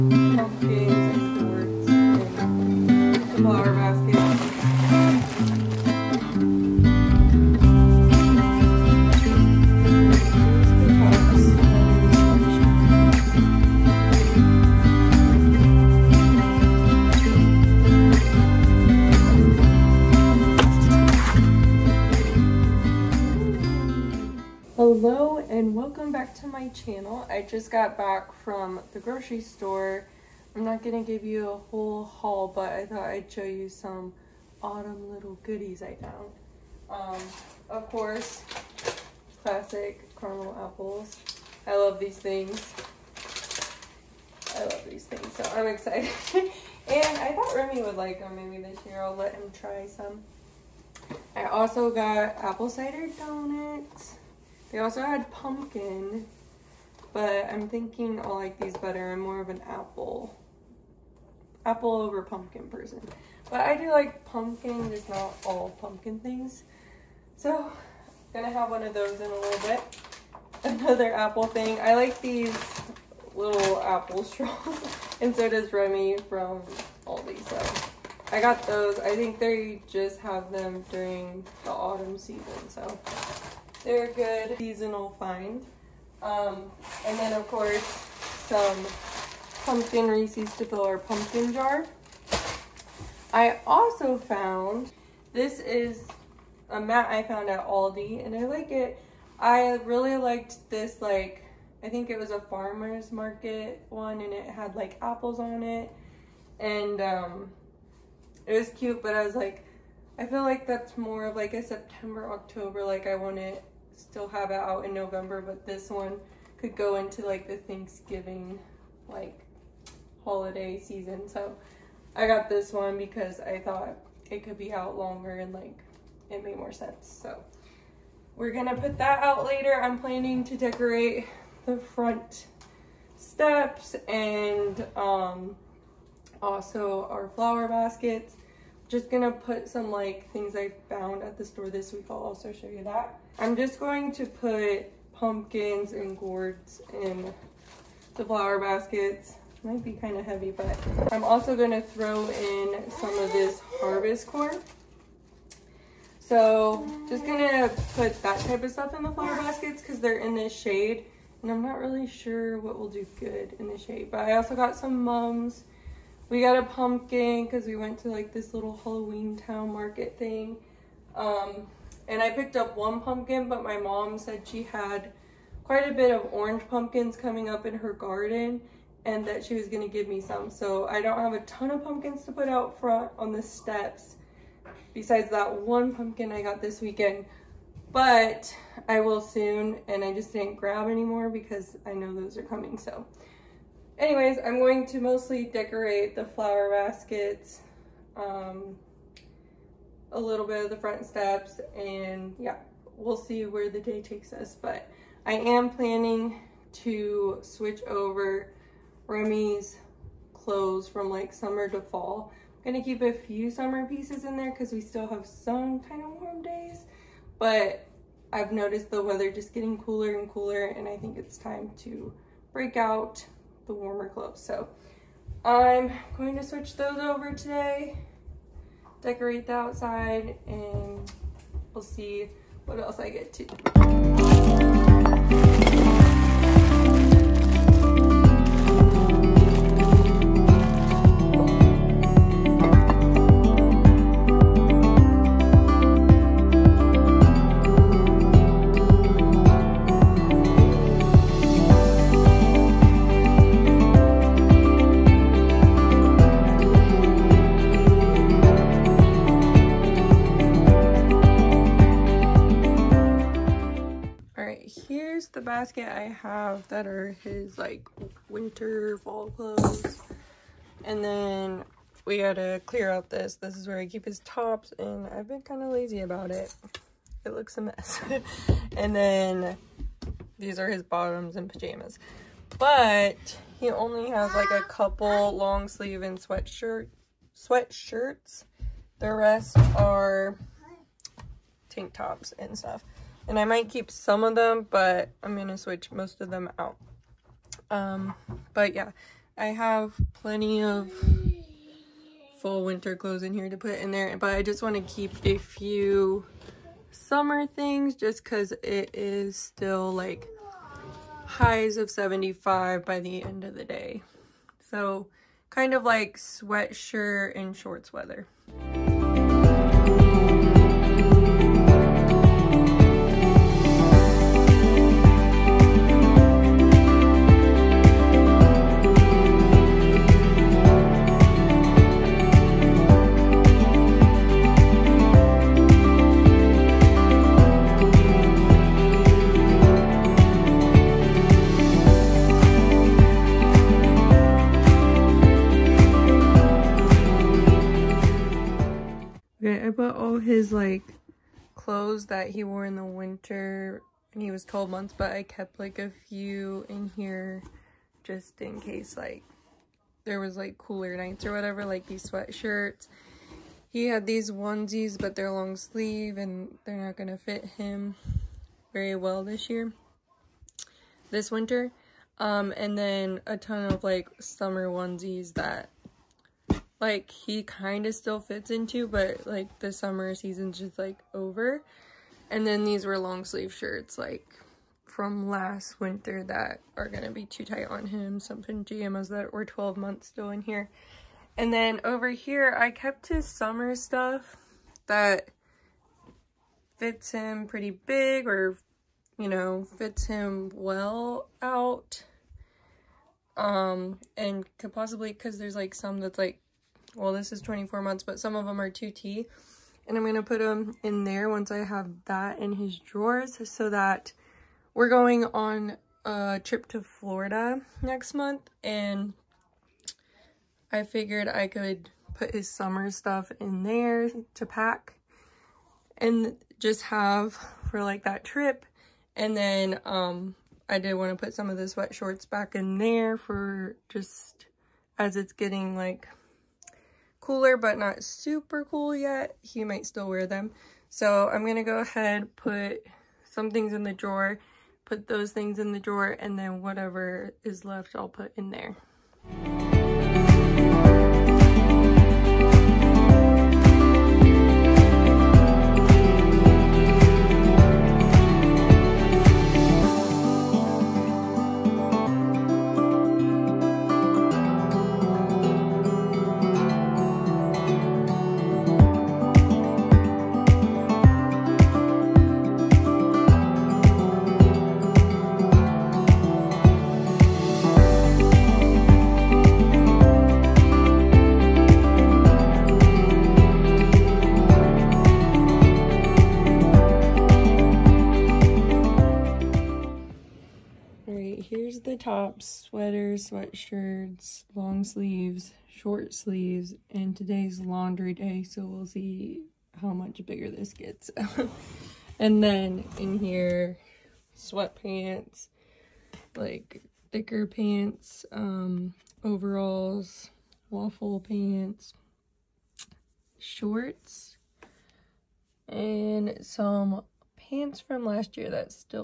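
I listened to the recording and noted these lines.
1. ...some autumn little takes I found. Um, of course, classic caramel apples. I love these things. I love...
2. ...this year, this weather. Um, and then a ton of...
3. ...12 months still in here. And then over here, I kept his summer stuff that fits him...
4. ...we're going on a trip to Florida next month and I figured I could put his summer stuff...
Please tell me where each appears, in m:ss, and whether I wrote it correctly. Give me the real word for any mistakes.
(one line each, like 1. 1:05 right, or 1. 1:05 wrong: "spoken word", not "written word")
1. 0:33 wrong: "goodies", not "takes"
2. 6:09 wrong: "winter", not "weather"
3. 6:29 right
4. 6:54 right.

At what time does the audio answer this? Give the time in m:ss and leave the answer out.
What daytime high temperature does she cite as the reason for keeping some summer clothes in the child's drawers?
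5:11.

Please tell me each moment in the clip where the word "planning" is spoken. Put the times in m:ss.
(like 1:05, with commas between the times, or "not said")
2:09, 3:25.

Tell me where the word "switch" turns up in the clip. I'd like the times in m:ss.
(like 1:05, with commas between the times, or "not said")
3:27, 3:46, 4:55.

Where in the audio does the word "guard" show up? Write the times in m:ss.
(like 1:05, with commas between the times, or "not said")
not said.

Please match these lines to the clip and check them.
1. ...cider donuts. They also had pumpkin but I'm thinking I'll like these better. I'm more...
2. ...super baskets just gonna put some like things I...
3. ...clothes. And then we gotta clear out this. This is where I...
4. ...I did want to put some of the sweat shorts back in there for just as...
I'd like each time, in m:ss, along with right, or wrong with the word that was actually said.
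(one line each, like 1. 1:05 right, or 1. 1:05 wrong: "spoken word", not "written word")
1. 0:52 right
2. 2:17 wrong: "flower", not "super"
3. 4:29 right
4. 7:10 right.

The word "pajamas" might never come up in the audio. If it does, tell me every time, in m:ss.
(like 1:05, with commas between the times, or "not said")
4:41, 6:28.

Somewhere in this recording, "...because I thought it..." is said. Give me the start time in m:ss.
2:02.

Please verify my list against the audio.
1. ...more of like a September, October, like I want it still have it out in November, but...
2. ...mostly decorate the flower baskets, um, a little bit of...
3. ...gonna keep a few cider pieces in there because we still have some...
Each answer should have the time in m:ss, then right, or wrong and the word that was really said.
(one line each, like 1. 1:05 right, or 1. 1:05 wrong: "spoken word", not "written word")
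1. 1:50 right
2. 3:14 right
3. 3:32 wrong: "summer", not "cider".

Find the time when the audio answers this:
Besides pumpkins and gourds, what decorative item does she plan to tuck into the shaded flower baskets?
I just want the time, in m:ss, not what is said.
2:33.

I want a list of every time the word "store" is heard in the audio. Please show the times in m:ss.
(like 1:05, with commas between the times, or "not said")
0:29, 2:21.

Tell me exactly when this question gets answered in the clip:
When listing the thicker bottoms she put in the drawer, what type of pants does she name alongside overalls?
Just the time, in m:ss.
8:30.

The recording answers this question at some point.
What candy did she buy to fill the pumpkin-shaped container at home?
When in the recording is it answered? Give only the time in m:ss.
1:29.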